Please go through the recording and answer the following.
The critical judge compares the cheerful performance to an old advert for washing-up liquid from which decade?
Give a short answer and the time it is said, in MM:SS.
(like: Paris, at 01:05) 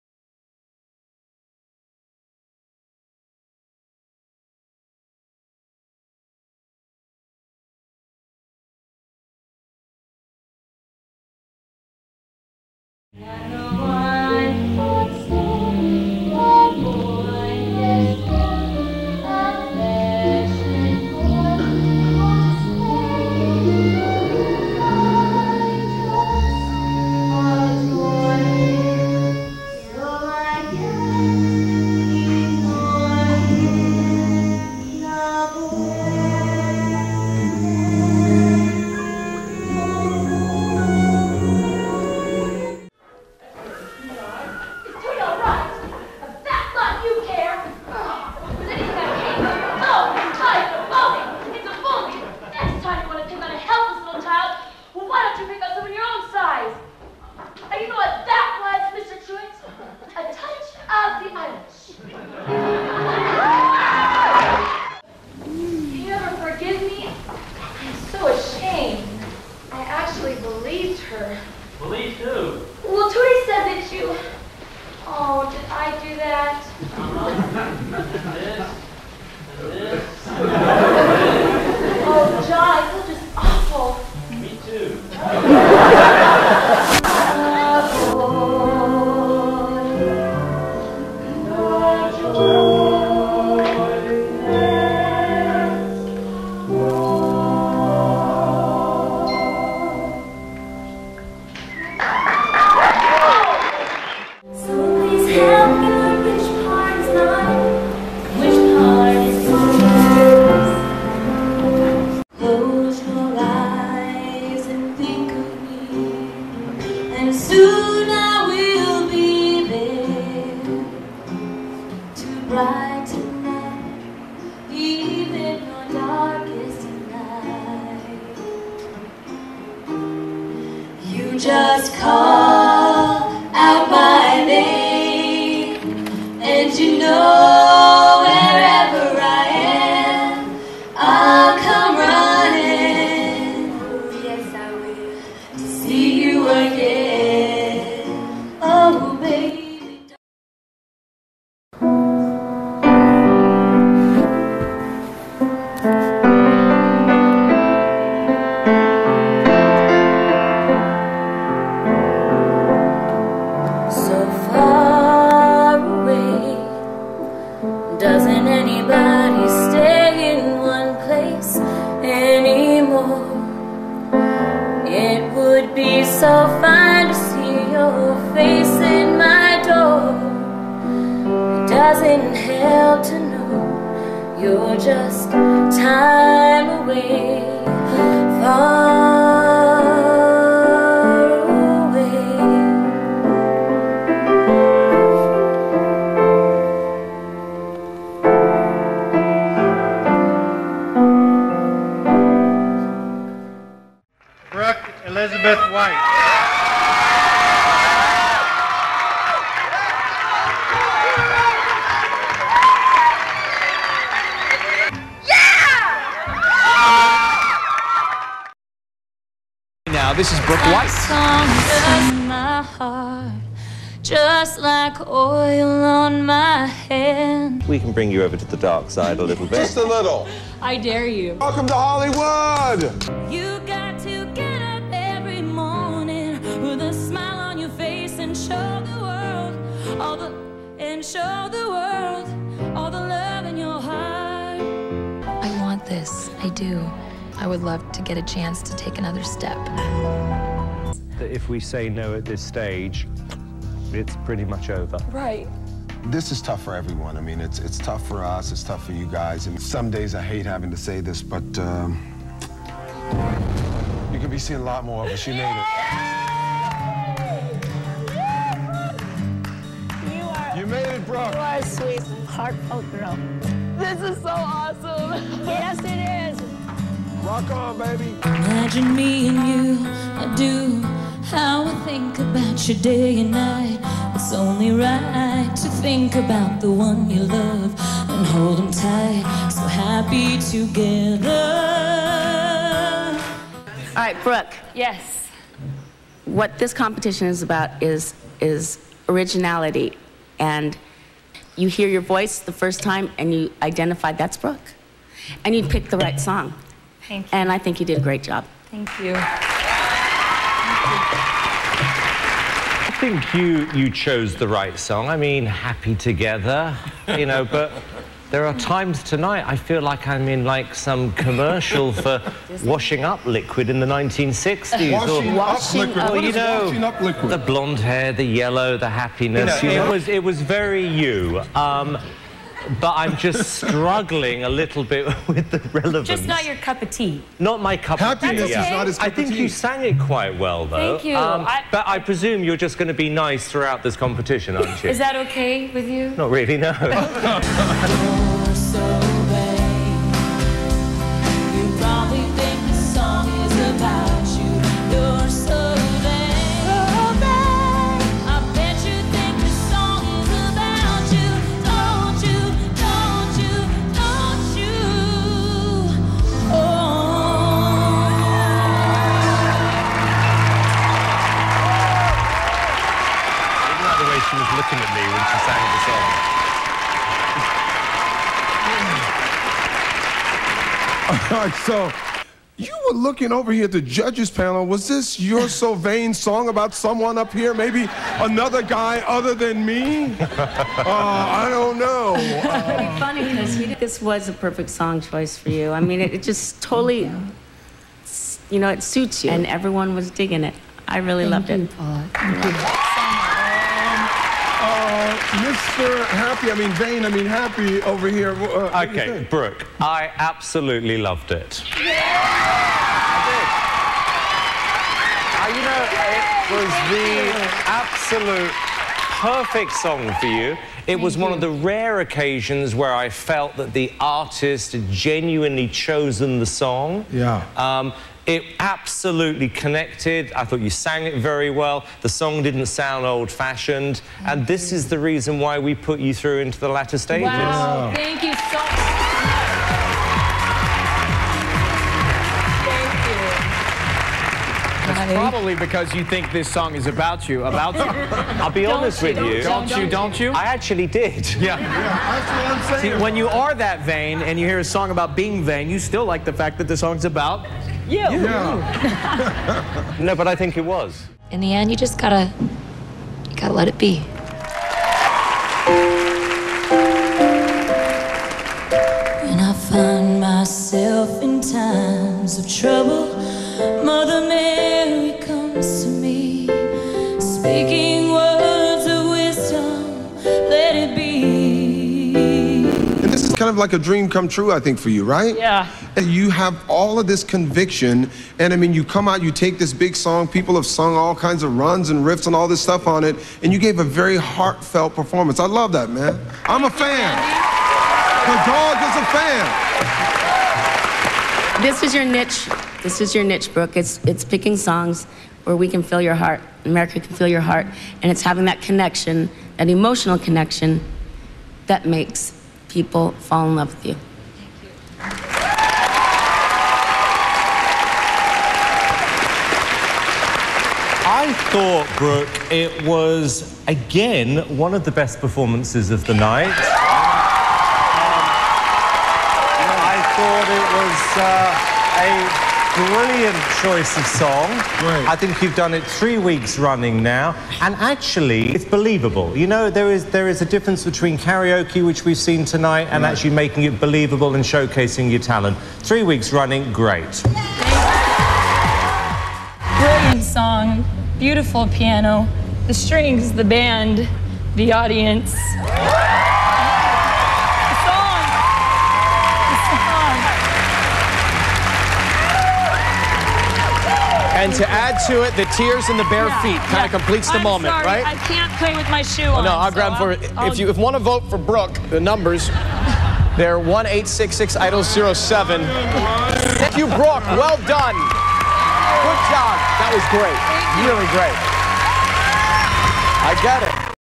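1960s, at 05:23.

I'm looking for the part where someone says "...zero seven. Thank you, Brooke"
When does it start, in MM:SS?
09:34.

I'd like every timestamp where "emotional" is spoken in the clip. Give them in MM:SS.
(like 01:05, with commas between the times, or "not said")
08:29.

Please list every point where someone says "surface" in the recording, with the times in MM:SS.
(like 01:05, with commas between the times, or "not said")
not said.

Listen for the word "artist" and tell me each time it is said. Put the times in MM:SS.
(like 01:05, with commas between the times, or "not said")
07:04.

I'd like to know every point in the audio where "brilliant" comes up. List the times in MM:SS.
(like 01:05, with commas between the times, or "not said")
08:52, 09:09.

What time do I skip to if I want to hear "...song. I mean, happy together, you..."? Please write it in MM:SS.
05:14.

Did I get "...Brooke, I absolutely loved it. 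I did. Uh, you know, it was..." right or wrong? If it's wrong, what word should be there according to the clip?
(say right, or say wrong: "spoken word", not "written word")
right.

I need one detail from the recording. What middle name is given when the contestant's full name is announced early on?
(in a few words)
Elizabeth.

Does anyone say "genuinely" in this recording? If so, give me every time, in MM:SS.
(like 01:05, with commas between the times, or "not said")
07:04.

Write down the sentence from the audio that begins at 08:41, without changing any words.
I thought, Brooke, it was again one of the best performances of the night.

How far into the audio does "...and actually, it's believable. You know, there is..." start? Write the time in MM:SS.
08:57.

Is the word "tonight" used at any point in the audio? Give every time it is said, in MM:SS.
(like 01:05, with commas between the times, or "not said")
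05:19, 09:02.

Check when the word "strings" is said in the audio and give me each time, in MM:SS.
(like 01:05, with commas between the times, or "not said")
09:12.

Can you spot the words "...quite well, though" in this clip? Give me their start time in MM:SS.
05:39.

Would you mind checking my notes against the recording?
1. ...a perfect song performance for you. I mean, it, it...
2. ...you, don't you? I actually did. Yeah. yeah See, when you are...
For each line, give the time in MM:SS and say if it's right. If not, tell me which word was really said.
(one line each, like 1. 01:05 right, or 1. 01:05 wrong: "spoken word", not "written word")
1. 06:34 wrong: "choice", not "performance"
2. 07:29 right.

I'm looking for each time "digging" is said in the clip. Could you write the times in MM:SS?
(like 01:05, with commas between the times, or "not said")
06:40.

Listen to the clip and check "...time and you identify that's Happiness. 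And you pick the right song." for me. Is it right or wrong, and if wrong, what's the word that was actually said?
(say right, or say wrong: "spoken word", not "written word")
wrong: "Brooke", not "Happiness".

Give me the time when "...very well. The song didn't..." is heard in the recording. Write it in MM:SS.
07:11.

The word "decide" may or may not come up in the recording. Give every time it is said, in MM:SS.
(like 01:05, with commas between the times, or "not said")
not said.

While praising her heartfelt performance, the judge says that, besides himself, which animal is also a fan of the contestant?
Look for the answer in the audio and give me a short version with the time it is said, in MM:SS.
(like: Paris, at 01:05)
The dog, at 08:18.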